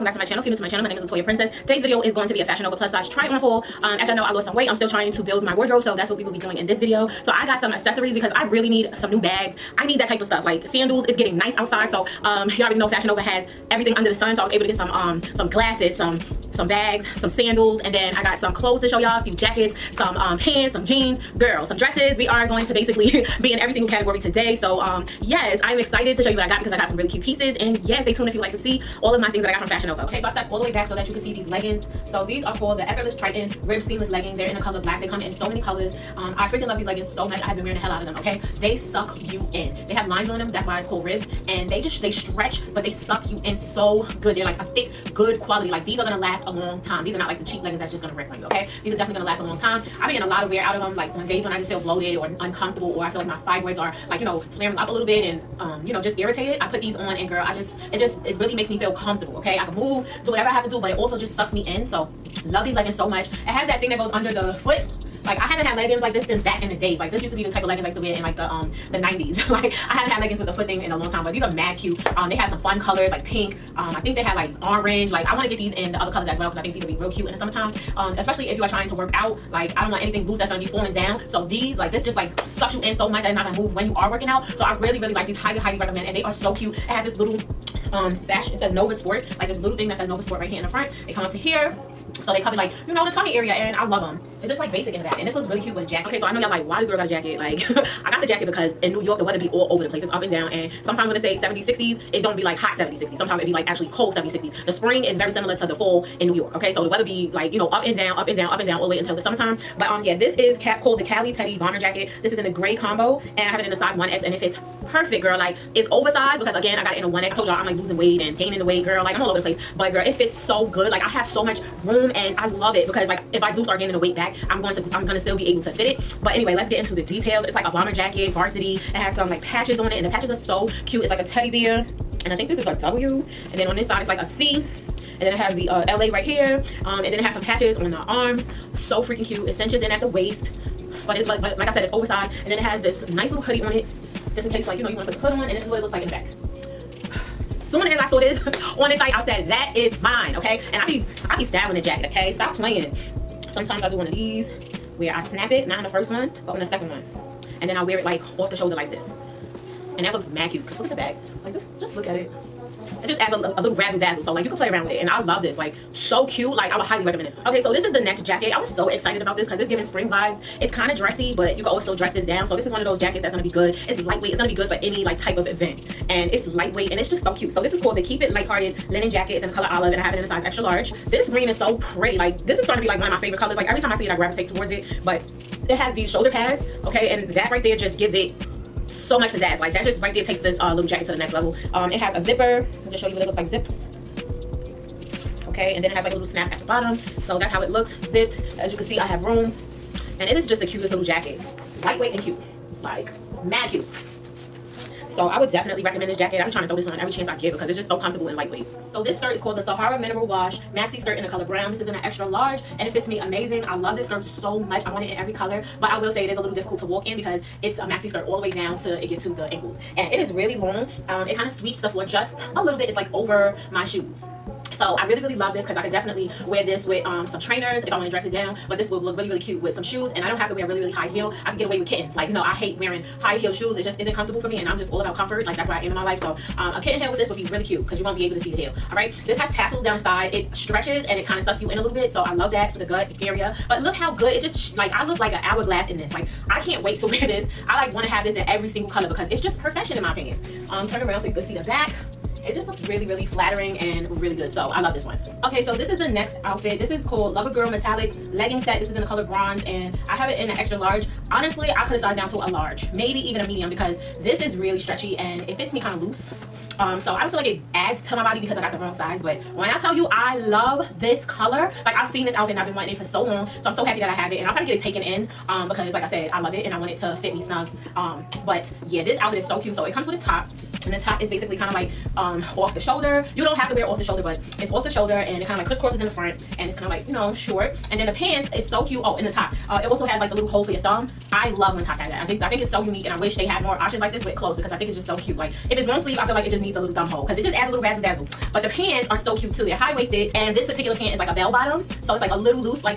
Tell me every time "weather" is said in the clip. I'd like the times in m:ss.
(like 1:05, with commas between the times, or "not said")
1:39, 1:46.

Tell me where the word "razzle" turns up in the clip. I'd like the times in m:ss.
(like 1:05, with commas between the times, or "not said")
2:43, 4:57.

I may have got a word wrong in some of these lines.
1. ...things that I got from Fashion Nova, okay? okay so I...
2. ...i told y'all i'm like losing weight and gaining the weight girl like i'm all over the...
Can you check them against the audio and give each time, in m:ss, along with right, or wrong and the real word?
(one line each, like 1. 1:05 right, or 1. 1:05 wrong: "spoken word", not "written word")
1. 0:29 right
2. 1:57 right.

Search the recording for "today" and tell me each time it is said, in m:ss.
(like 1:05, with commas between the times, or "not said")
0:01, 0:24.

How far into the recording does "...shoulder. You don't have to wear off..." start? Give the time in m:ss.
4:42.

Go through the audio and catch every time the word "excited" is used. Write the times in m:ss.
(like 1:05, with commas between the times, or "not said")
0:25, 2:48.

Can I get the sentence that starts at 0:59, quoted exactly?
I can move, do whatever I have to do, but it also just sucks me in.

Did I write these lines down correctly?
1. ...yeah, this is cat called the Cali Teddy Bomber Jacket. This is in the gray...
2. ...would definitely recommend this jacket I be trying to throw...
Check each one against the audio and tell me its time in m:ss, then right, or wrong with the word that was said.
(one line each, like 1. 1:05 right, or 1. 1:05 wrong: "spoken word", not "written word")
1. 1:50 right
2. 3:25 right.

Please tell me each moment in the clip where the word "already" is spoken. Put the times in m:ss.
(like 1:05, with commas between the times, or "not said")
0:12.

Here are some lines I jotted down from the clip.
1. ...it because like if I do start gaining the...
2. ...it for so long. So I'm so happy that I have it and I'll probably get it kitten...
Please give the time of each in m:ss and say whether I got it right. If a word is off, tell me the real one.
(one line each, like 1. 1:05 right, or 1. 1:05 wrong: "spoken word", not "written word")
1. 2:02 right
2. 4:32 wrong: "taken", not "kitten".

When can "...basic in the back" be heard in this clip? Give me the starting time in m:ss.
1:34.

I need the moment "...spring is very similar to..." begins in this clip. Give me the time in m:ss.
1:44.